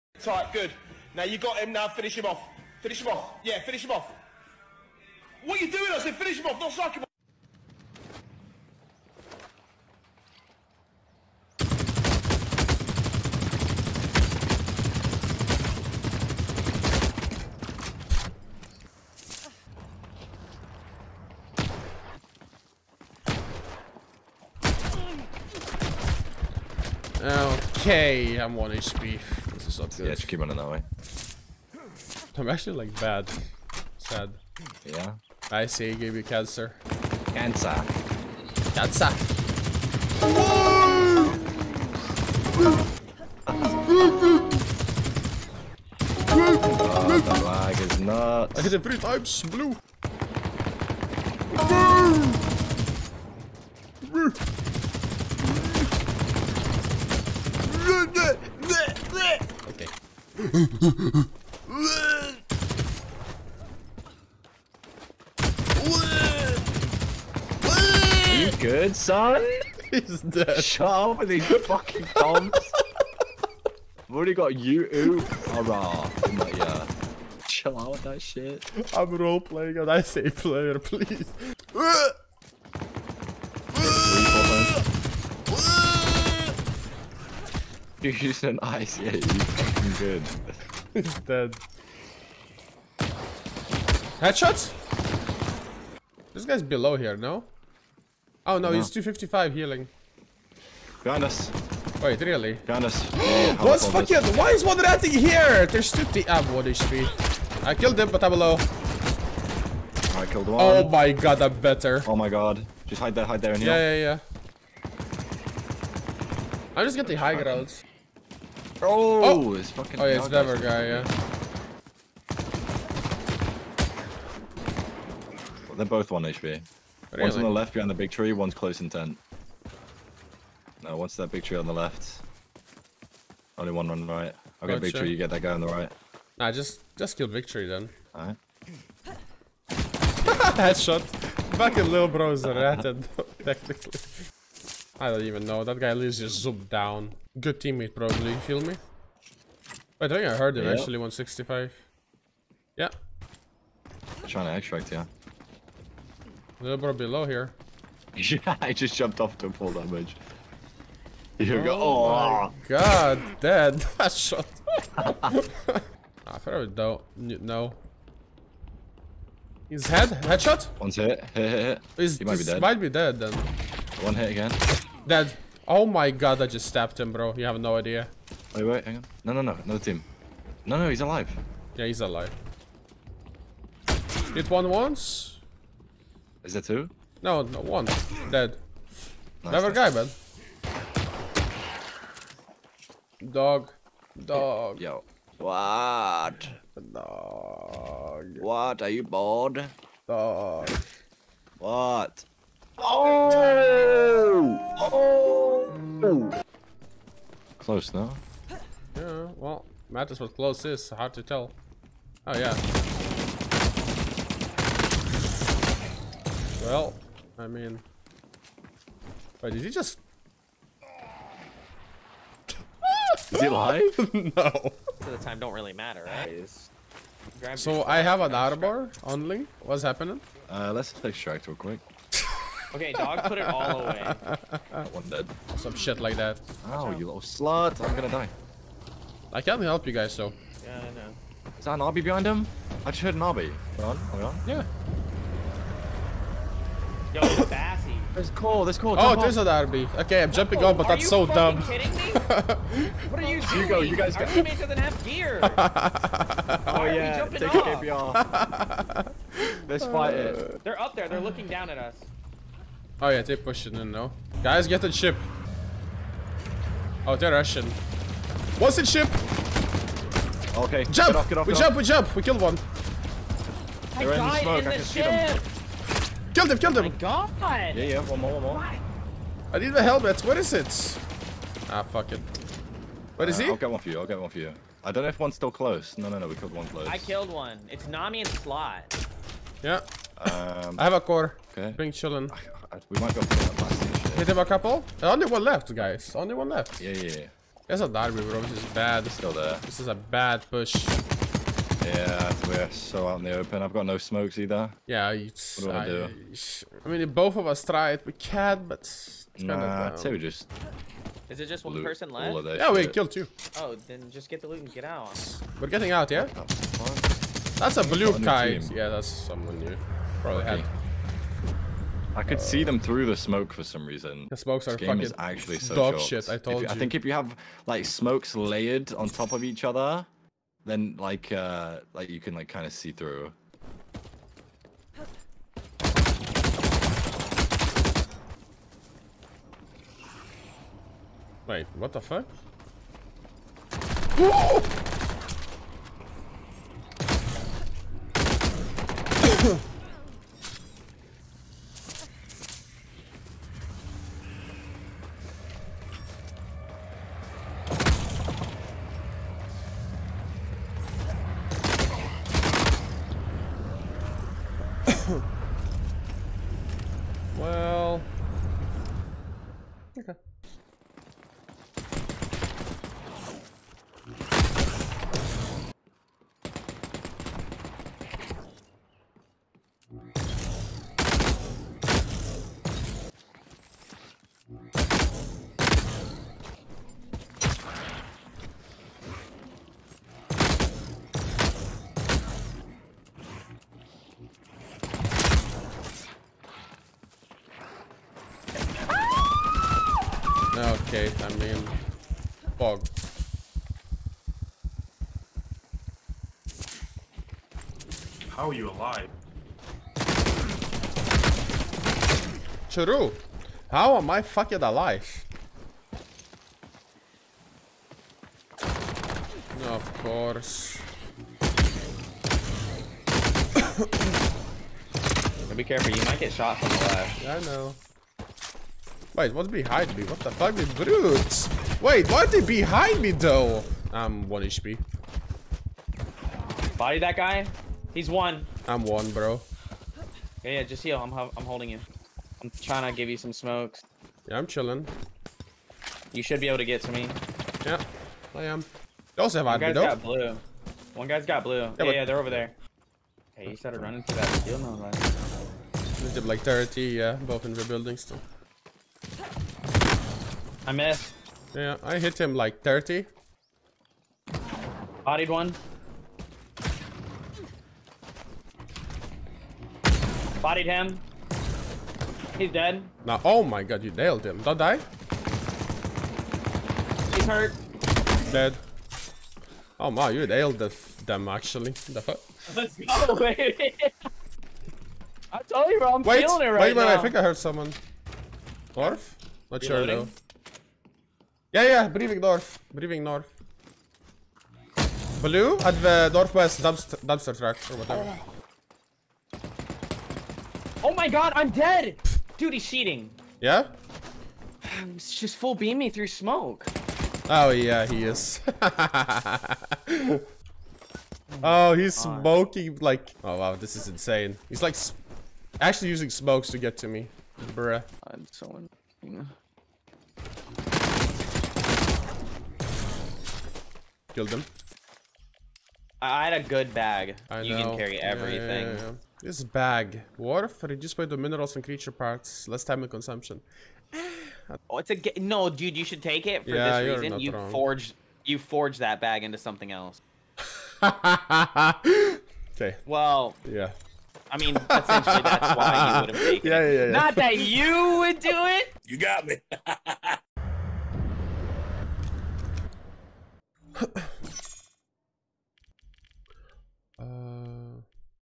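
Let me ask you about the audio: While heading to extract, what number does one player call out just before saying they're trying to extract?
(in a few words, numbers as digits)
165.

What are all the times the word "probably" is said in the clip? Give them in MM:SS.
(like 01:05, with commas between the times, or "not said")
02:27, 05:20.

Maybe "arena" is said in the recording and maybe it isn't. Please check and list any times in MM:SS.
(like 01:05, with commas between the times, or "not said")
not said.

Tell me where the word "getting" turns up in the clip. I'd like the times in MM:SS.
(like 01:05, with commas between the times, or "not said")
01:56, 05:15.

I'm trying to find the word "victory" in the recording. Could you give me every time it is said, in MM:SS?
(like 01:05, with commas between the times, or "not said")
02:17.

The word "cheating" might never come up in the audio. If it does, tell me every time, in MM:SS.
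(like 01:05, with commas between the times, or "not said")
08:22.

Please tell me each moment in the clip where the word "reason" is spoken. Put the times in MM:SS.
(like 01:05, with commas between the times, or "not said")
05:23, 08:57.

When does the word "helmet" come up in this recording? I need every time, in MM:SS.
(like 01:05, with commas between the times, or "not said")
04:39.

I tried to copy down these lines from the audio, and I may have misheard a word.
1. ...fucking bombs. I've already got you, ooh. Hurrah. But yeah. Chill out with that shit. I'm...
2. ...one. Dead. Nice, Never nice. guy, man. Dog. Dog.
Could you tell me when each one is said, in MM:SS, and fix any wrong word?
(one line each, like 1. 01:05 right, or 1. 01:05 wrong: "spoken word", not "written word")
1. 01:11 right
2. 03:07 right.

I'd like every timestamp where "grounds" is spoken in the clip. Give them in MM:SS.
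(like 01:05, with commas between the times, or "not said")
01:57.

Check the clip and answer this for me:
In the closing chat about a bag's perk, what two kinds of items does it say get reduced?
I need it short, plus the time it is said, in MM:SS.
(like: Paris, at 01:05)
minerals and creature parts, at 08:51.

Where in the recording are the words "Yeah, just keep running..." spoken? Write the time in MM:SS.
00:30.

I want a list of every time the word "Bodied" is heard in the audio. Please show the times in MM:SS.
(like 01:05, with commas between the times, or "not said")
07:45, 07:50.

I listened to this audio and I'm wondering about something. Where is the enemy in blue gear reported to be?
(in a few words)
northwest dumpster.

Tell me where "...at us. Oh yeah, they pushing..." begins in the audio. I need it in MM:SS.
04:21.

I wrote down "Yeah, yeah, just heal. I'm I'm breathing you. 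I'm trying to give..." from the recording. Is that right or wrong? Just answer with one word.
wrong.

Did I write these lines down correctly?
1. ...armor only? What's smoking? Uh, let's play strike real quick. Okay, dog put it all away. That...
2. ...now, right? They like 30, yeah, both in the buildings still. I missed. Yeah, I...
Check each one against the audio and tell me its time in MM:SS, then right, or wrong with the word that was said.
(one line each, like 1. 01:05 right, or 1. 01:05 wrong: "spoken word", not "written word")
1. 03:48 wrong: "happening", not "smoking"
2. 07:34 right.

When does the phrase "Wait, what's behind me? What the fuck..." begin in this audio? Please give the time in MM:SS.
07:09.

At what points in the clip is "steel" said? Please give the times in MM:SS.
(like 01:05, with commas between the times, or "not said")
07:34.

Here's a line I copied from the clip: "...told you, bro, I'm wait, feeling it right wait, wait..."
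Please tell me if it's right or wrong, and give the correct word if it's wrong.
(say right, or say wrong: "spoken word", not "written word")
right.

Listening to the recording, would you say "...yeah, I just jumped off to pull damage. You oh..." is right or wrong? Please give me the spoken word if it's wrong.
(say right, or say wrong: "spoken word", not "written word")
right.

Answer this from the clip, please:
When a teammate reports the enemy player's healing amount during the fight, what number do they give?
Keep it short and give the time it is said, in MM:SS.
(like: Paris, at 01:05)
255, at 01:38.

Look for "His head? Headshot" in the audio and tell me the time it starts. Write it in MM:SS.
02:49.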